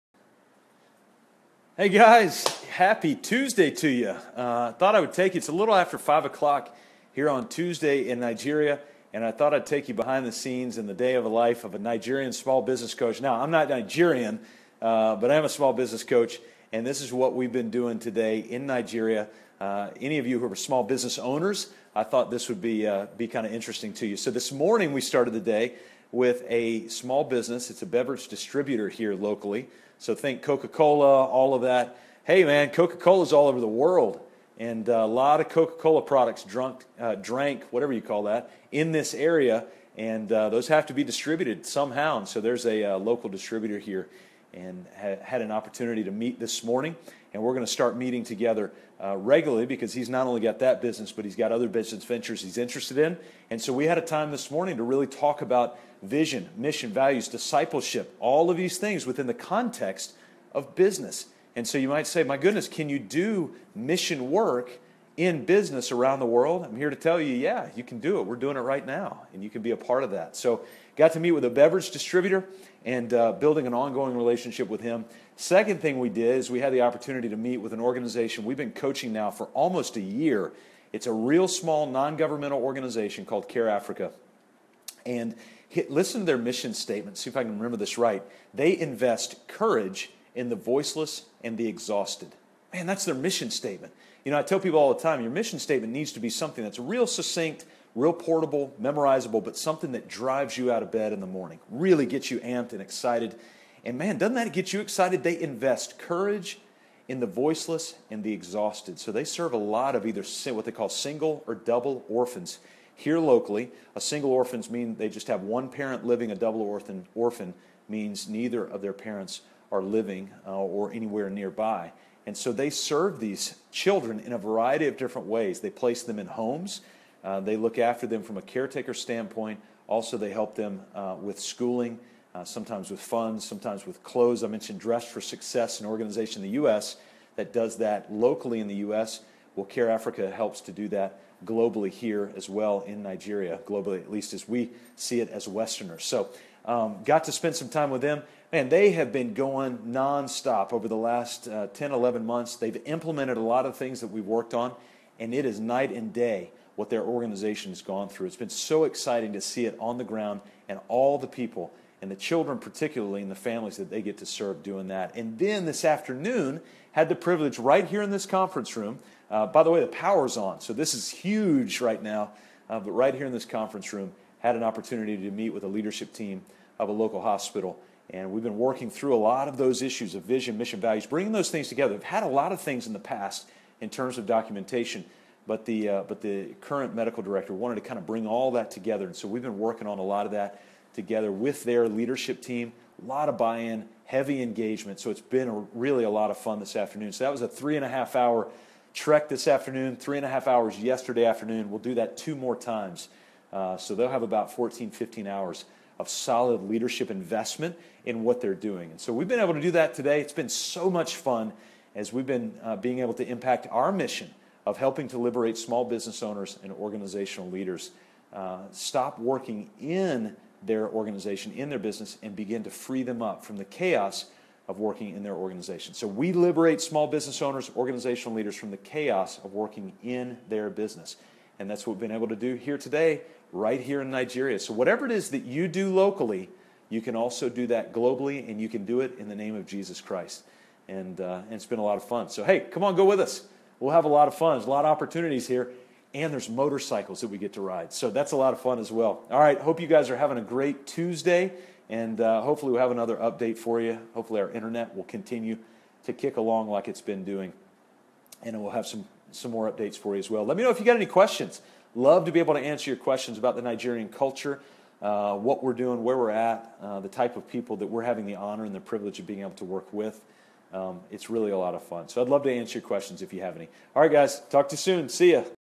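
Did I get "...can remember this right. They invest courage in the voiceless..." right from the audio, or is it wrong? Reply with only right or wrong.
right.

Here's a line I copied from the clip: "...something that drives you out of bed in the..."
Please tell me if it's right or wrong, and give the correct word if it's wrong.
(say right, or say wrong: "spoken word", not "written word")
right.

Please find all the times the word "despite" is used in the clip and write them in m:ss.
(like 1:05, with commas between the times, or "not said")
not said.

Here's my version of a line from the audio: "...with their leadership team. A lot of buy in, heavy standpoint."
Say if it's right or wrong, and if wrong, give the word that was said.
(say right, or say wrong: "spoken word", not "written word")
wrong: "engagement", not "standpoint".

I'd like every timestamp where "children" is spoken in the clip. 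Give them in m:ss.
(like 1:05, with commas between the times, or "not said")
2:03, 2:42.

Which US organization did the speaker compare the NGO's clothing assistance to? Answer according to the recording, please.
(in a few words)
Dress for Success.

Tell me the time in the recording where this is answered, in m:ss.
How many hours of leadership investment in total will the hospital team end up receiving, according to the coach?
3:24.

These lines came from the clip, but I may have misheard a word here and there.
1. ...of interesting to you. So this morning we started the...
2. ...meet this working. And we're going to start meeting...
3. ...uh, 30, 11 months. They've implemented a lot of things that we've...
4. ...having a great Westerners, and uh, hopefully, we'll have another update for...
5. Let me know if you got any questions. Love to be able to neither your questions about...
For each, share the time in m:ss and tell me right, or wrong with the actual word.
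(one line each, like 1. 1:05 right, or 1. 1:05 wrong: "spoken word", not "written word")
1. 0:23 right
2. 0:46 wrong: "morning", not "working"
3. 2:31 wrong: "10", not "30"
4. 4:10 wrong: "Tuesday", not "Westerners"
5. 4:20 wrong: "answer", not "neither".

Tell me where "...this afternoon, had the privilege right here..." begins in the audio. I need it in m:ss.
2:45.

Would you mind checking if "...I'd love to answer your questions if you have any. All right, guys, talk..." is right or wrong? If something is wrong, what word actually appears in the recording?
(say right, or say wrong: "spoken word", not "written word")
right.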